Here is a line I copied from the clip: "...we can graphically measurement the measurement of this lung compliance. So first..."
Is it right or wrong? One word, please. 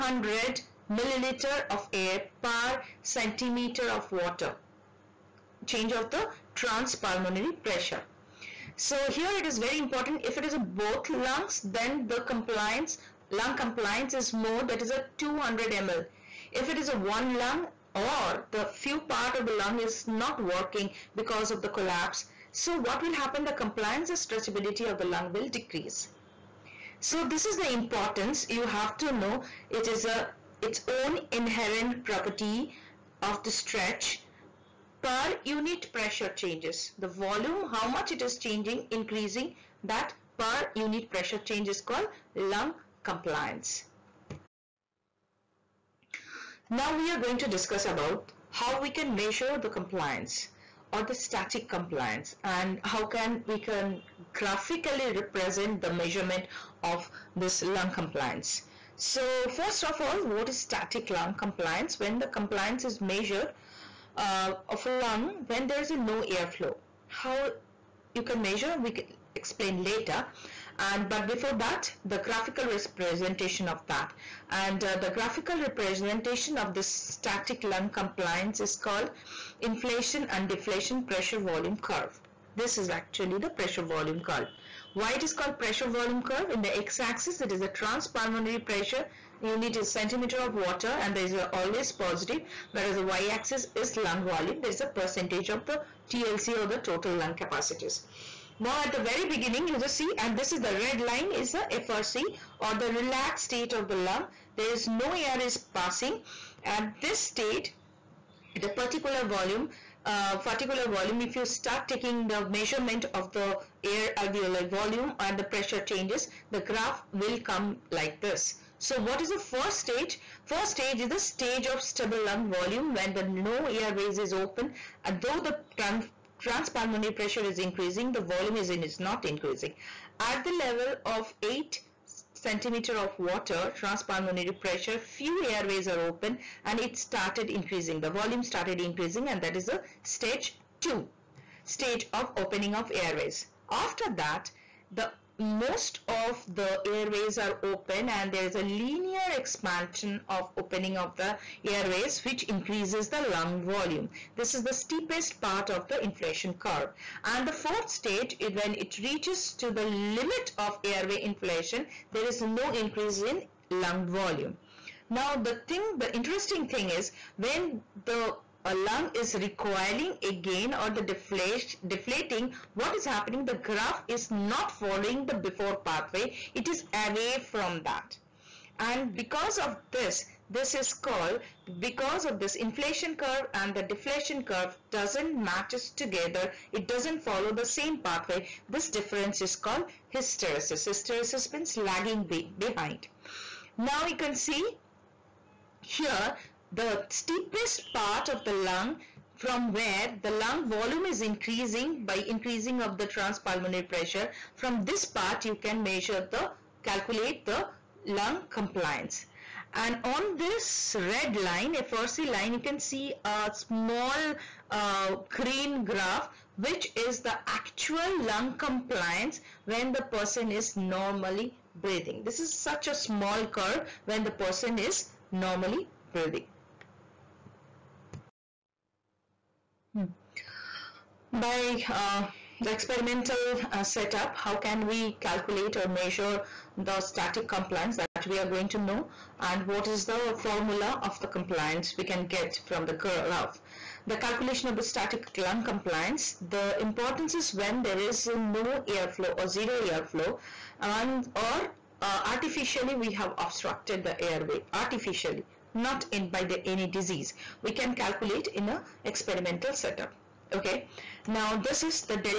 wrong.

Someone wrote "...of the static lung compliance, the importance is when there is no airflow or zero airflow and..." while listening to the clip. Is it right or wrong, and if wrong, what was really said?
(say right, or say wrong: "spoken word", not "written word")
right.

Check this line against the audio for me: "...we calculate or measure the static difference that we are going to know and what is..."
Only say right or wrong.
wrong.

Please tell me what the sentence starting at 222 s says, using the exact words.
This is such a small curve when the person is normally breathing.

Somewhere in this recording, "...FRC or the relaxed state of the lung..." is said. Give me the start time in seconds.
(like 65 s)
101 s.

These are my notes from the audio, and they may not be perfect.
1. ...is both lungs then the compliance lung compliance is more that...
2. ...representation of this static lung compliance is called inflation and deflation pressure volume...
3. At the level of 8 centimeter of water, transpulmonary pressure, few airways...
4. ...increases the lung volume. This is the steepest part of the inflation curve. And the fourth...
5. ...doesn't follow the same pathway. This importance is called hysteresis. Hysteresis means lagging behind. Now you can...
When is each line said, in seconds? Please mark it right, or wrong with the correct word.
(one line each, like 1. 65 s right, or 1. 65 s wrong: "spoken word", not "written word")
1. 10 s right
2. 75 s right
3. 130 s right
4. 152 s right
5. 186 s wrong: "difference", not "importance".